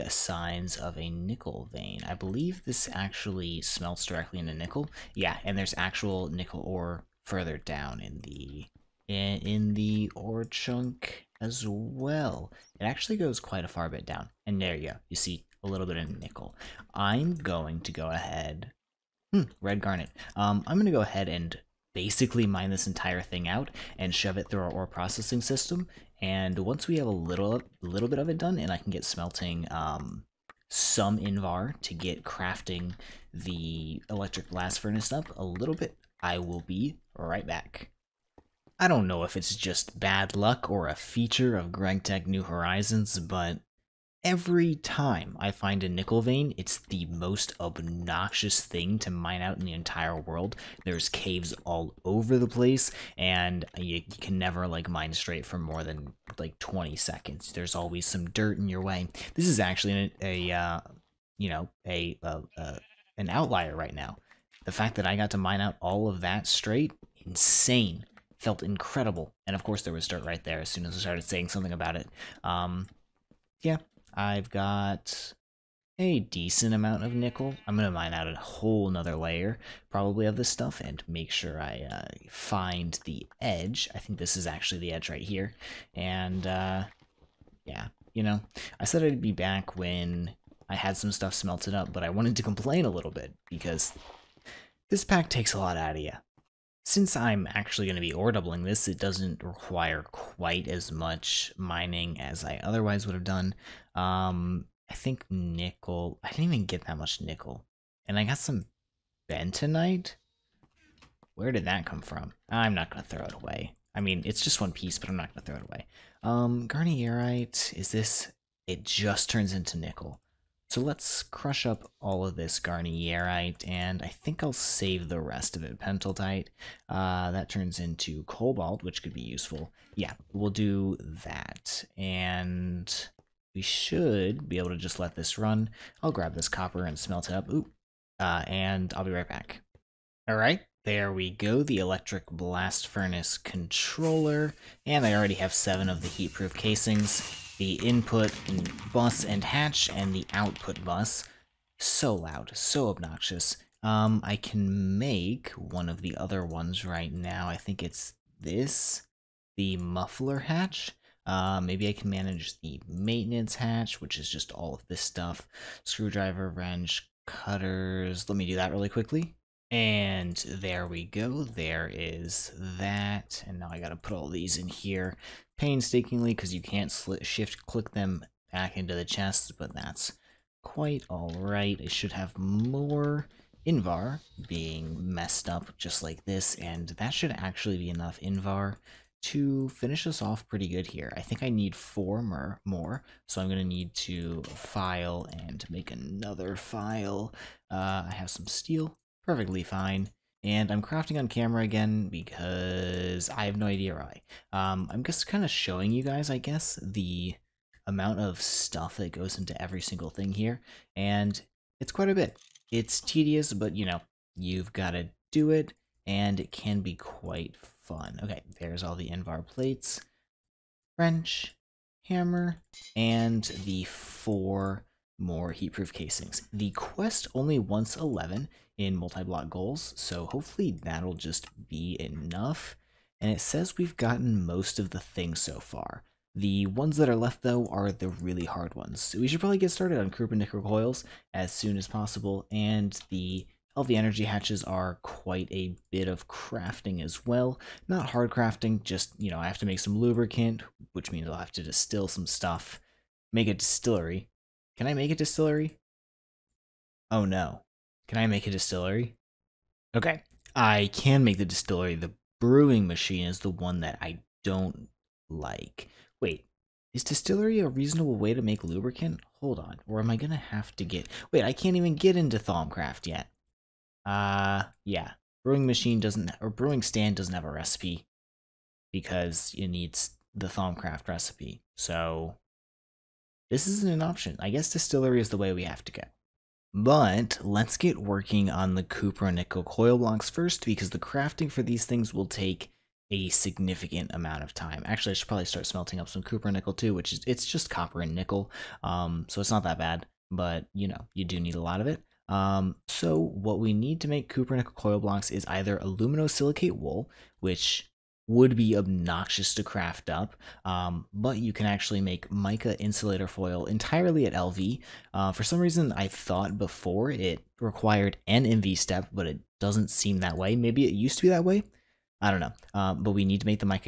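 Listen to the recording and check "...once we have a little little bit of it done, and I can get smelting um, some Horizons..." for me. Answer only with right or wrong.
wrong.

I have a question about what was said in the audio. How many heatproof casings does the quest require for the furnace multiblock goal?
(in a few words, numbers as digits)
11.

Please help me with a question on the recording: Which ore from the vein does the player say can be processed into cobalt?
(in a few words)
Pentlandite.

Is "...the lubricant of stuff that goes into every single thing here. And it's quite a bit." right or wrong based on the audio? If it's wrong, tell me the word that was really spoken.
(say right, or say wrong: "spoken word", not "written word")
wrong: "amount", not "lubricant".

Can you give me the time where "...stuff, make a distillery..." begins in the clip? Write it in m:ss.
4:12.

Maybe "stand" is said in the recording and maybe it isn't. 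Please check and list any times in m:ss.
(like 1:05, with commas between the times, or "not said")
4:36.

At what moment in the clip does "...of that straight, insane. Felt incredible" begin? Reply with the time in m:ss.
1:06.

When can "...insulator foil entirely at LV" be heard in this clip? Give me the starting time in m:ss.
5:12.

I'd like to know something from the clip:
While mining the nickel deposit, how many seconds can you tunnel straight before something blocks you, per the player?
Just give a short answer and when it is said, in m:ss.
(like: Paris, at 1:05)
20, at 0:56.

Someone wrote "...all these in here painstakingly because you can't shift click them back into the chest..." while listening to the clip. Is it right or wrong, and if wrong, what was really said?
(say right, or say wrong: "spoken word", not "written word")
right.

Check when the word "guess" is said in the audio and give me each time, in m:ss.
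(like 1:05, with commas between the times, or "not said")
3:26, 4:44.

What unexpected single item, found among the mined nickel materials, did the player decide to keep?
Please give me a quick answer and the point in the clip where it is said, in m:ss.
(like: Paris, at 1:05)
bentonite, at 1:49.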